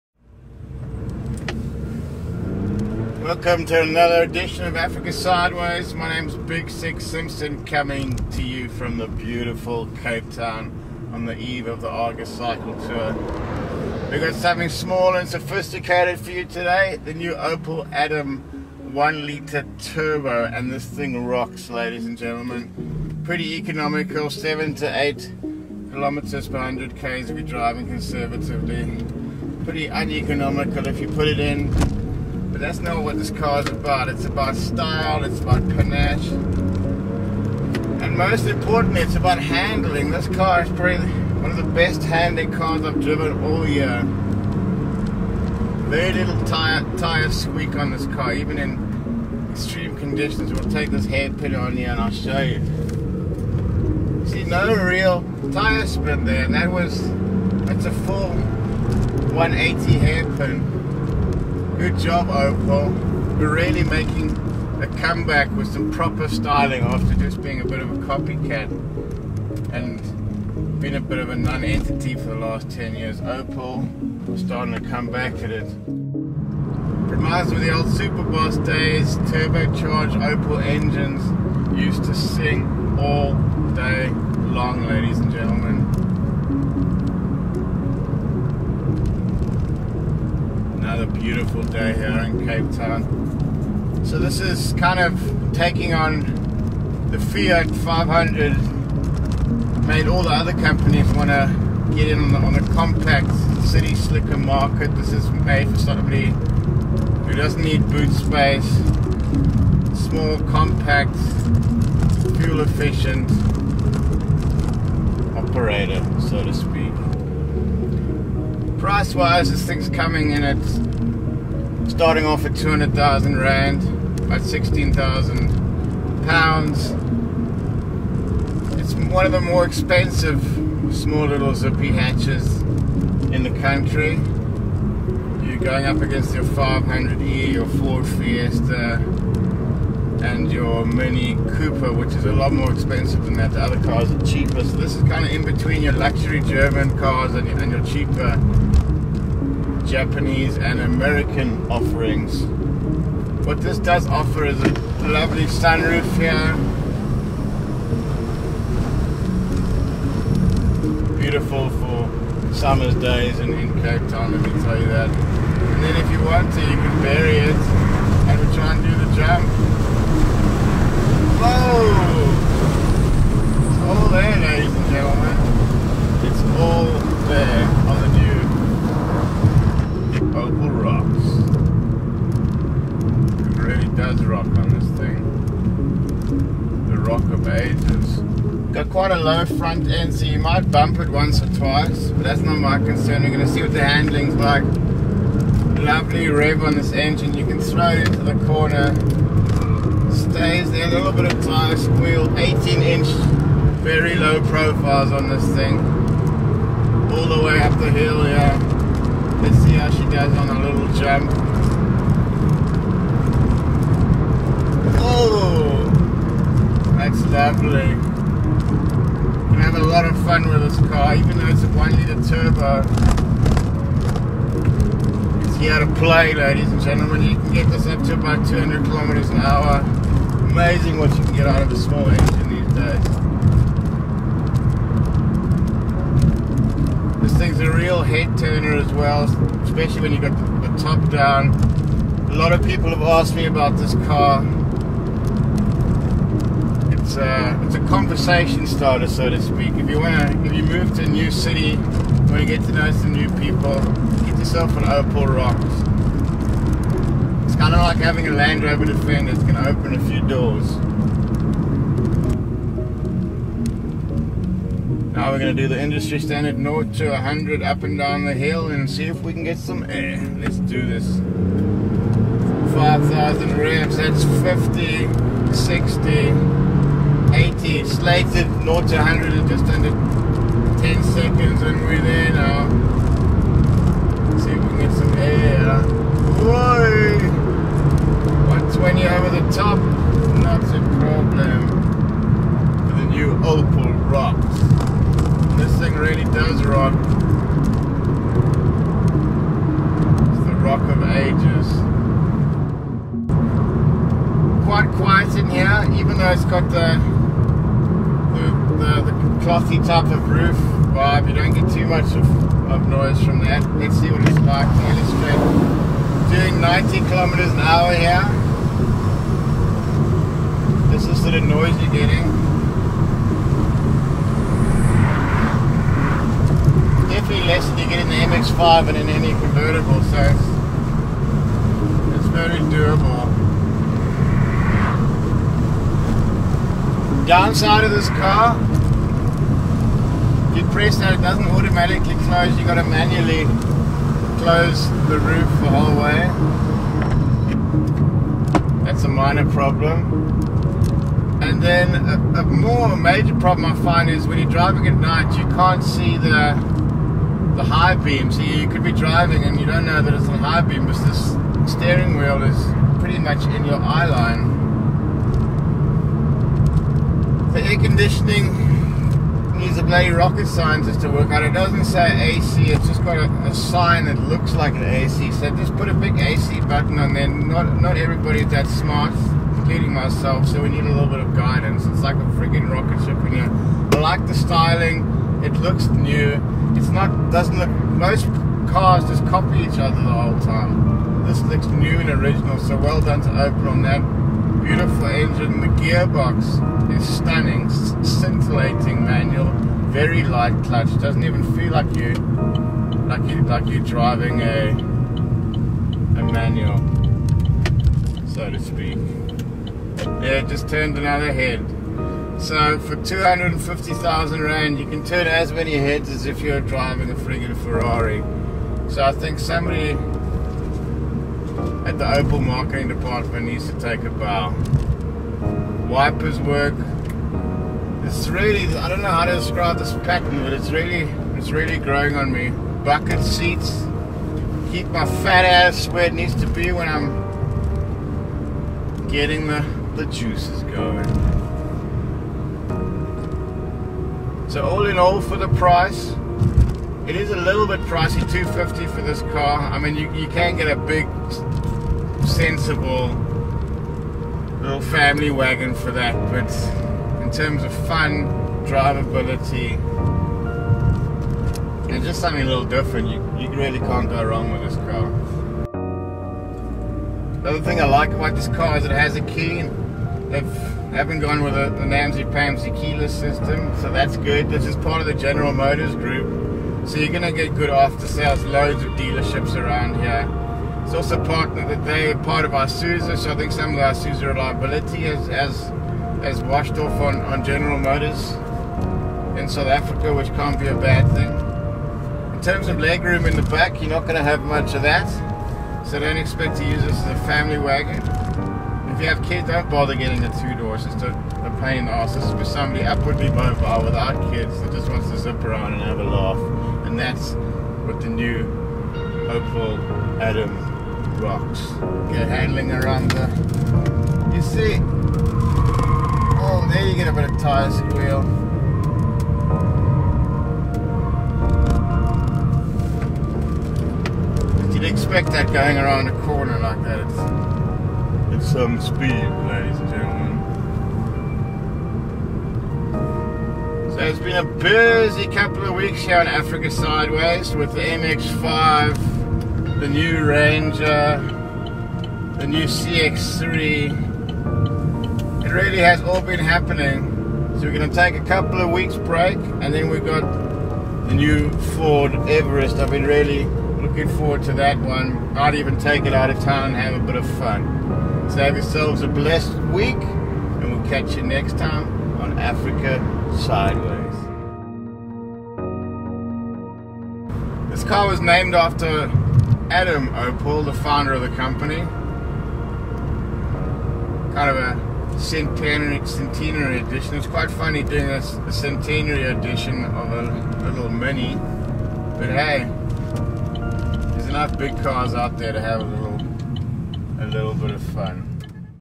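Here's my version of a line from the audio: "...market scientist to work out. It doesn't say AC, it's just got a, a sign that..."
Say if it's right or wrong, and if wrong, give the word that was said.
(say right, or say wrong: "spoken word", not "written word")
wrong: "rocket", not "market".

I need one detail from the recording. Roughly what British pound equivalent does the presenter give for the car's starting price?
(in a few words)
16,000 pounds.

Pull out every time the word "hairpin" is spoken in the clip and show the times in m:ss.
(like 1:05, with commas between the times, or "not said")
0:51, 0:59.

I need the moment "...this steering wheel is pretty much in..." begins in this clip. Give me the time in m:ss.
6:01.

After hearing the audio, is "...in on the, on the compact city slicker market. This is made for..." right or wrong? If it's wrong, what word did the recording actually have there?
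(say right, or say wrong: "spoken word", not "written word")
right.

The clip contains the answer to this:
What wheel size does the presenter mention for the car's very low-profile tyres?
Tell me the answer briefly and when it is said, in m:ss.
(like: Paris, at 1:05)
18 inch, at 3:22.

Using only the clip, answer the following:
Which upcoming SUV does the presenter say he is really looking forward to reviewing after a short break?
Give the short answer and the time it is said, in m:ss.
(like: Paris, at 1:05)
Ford Everest, at 9:11.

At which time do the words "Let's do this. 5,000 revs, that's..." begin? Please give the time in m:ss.
4:30.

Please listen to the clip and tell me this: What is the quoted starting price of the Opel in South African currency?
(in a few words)
200,000 Rand.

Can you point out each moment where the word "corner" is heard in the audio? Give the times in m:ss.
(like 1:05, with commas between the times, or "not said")
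3:18, 8:46.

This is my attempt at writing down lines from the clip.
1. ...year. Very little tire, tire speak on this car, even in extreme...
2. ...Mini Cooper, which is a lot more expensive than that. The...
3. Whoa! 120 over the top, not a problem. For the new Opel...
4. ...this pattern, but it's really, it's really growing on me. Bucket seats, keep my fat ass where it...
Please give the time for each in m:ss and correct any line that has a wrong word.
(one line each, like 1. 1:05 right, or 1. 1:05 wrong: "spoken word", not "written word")
1. 0:43 wrong: "squeak", not "speak"
2. 2:20 right
3. 4:46 right
4. 7:09 right.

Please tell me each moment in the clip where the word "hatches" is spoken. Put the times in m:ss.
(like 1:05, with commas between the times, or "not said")
2:11.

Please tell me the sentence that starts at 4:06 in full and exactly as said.
It's a, uh, it's a conversation starter, so to speak.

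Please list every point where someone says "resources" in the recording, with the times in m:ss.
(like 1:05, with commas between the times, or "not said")
not said.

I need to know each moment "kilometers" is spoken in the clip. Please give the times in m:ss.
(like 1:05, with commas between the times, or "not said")
0:25, 3:48, 5:17.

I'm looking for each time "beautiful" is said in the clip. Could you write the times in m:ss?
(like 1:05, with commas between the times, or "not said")
0:09, 1:31, 2:41, 6:34.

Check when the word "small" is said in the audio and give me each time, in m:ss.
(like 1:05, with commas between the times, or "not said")
0:14, 1:49, 2:10, 3:51.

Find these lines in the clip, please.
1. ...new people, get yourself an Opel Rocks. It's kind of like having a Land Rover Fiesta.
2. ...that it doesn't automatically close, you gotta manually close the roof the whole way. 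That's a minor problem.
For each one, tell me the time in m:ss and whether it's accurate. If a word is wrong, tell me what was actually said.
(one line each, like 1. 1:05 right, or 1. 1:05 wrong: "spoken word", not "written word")
1. 4:13 wrong: "Defender", not "Fiesta"
2. 5:40 right.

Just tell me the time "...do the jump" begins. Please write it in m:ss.
2:48.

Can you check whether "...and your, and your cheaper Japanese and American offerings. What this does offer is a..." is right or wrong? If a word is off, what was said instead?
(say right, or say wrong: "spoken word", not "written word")
right.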